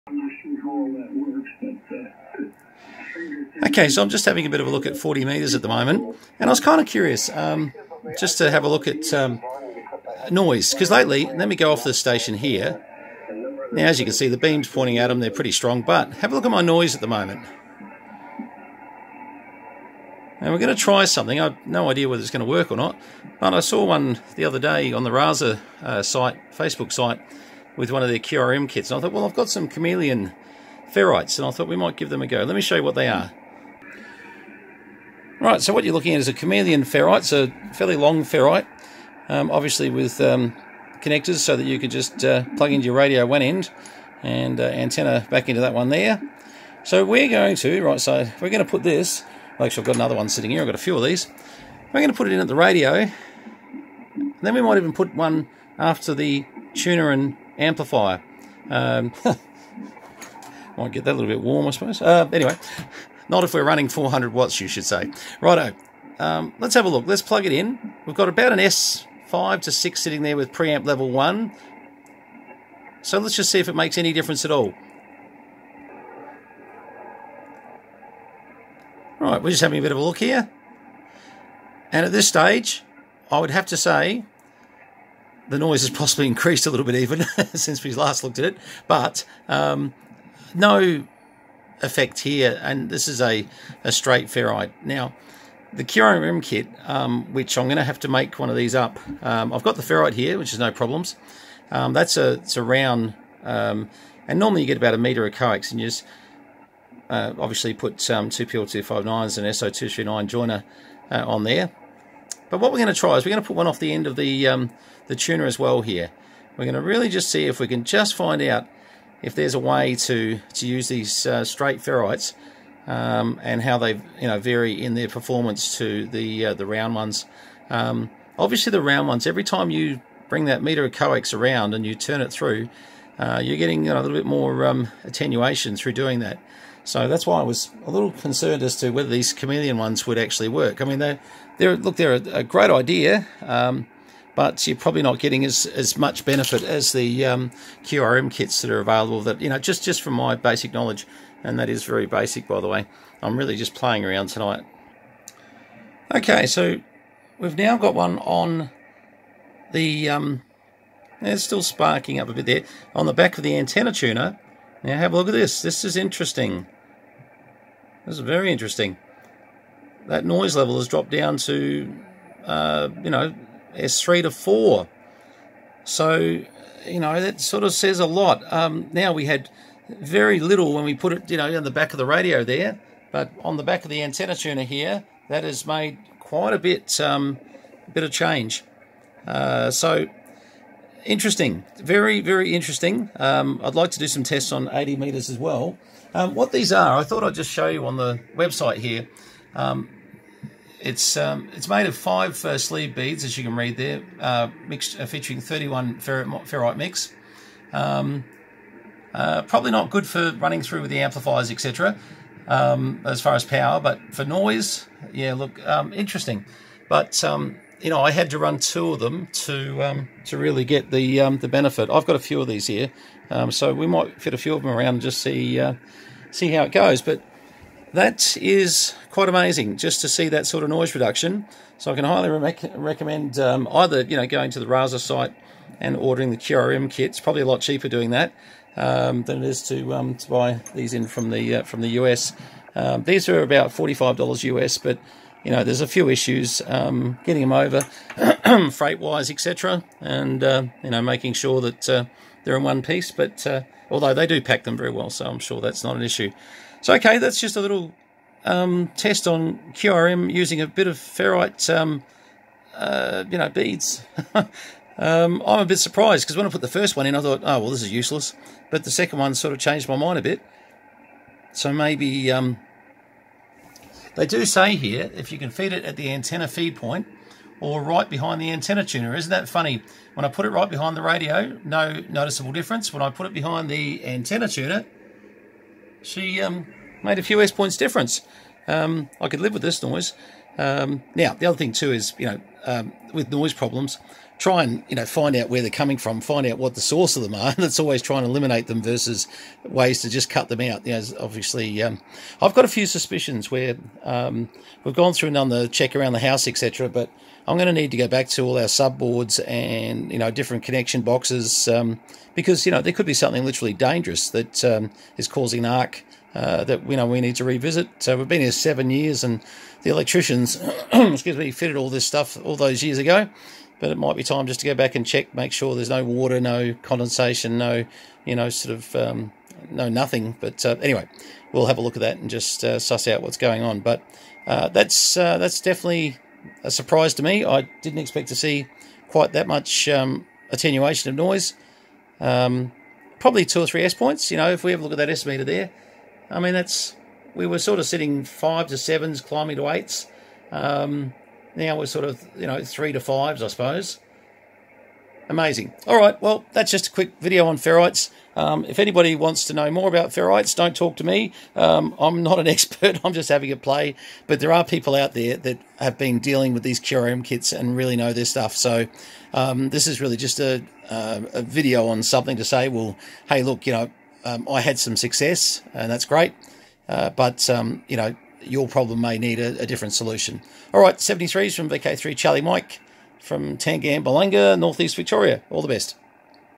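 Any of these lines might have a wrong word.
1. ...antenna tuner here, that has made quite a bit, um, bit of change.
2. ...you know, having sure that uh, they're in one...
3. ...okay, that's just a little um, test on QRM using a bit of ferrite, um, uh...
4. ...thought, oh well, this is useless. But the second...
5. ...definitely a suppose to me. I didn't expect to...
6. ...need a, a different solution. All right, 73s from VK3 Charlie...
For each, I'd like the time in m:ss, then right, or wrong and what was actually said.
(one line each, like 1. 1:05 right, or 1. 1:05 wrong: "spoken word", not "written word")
1. 3:04 right
2. 4:10 wrong: "making", not "having"
3. 4:16 right
4. 4:27 right
5. 5:35 wrong: "surprise", not "suppose"
6. 6:19 right.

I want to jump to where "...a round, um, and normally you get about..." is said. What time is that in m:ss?
1:42.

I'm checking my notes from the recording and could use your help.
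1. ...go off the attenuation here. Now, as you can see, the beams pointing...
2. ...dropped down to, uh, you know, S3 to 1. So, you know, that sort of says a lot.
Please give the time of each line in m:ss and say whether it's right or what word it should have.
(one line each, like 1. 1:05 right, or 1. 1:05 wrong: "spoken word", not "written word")
1. 0:11 wrong: "station", not "attenuation"
2. 2:50 wrong: "4", not "1".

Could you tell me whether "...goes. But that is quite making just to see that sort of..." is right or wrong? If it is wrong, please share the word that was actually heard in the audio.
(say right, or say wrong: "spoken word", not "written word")
wrong: "amazing", not "making".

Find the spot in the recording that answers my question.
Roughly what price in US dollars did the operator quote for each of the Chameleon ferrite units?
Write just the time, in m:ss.
4:03.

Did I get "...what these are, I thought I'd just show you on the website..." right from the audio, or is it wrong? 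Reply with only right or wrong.
right.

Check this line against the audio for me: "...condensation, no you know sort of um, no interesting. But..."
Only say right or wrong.
wrong.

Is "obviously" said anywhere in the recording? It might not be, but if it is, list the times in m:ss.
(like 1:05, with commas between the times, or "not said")
0:39, 1:47, 2:08, 5:01.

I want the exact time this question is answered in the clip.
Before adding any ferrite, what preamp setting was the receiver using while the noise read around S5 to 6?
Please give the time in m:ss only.
1:10.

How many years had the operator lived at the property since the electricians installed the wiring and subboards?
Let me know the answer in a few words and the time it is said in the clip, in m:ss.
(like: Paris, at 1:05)
7, at 5:18.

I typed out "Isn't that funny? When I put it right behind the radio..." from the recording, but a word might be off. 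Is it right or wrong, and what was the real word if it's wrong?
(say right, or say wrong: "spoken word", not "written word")
right.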